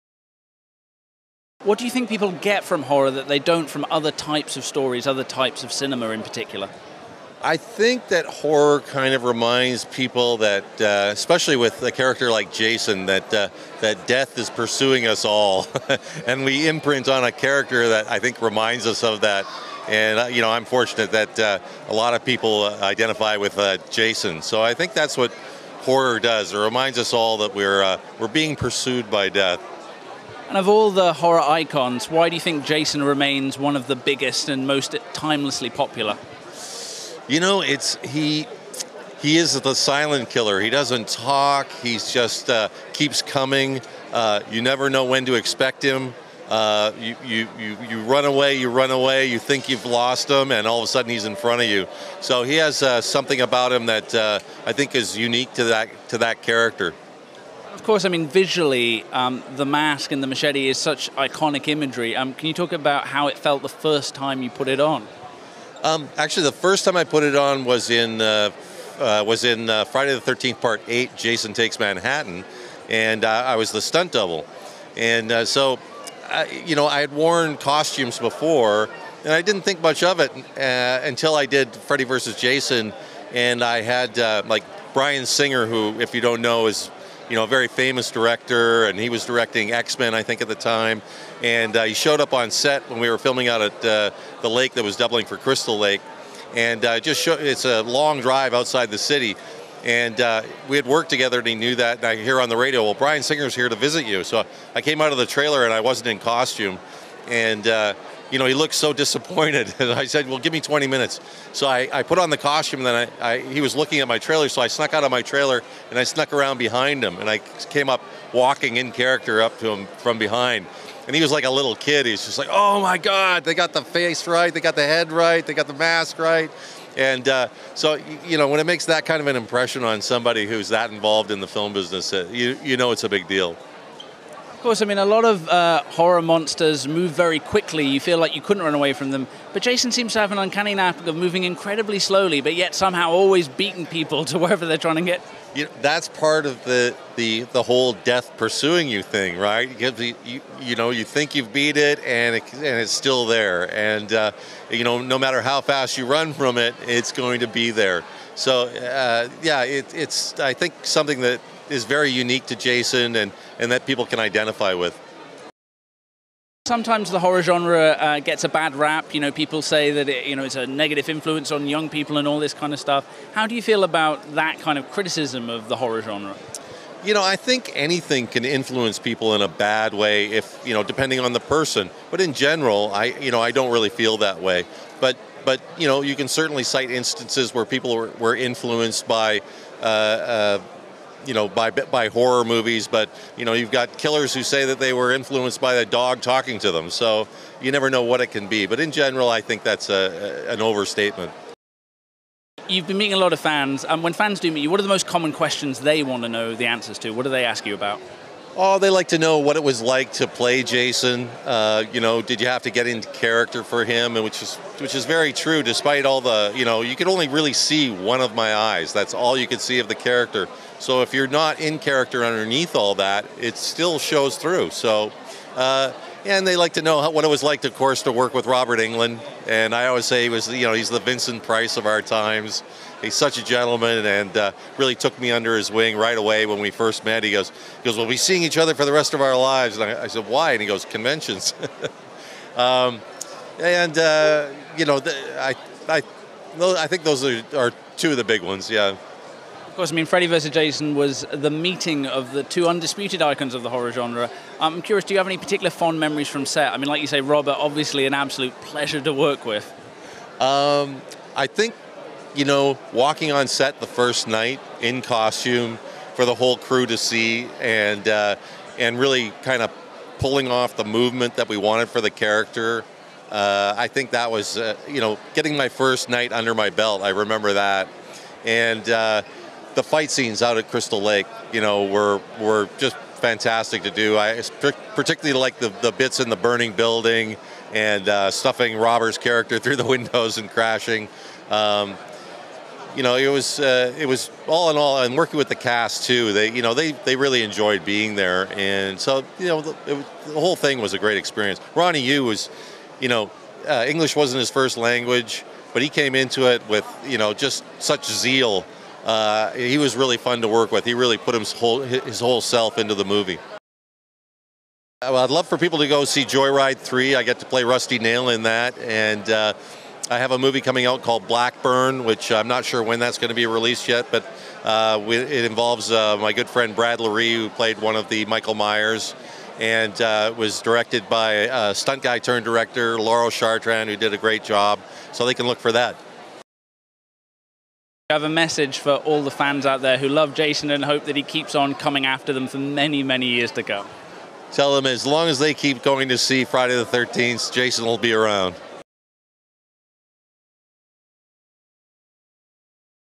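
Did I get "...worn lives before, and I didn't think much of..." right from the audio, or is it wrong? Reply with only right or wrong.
wrong.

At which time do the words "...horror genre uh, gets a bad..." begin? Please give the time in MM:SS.
02:47.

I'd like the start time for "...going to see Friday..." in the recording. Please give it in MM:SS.
05:45.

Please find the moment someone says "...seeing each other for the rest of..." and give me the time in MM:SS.
03:58.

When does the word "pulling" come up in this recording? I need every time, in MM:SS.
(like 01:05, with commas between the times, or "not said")
04:30.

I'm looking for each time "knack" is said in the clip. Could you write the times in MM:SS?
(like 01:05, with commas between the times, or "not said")
02:20.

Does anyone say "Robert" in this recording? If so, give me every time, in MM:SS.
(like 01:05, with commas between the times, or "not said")
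03:48, 04:17, 04:48.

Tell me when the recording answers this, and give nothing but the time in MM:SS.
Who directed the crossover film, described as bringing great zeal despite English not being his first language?
05:01.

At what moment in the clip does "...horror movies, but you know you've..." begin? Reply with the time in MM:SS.
03:12.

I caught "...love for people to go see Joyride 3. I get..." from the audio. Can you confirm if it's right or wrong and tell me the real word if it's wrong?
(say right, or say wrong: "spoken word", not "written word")
right.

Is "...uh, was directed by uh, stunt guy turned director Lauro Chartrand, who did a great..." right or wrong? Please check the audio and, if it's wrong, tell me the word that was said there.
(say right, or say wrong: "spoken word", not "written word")
right.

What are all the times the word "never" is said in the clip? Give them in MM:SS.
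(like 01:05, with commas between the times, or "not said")
00:44, 03:17.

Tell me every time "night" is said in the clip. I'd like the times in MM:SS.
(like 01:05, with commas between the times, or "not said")
04:24, 04:36.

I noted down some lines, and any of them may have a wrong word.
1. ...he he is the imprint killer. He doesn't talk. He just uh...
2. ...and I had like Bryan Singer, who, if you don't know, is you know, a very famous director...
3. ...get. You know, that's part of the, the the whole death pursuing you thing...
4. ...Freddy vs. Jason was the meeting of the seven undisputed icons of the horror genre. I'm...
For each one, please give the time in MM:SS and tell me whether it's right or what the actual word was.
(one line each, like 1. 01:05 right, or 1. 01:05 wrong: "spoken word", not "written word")
1. 00:38 wrong: "silent", not "imprint"
2. 01:23 right
3. 02:25 right
4. 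04:10 wrong: "two", not "seven".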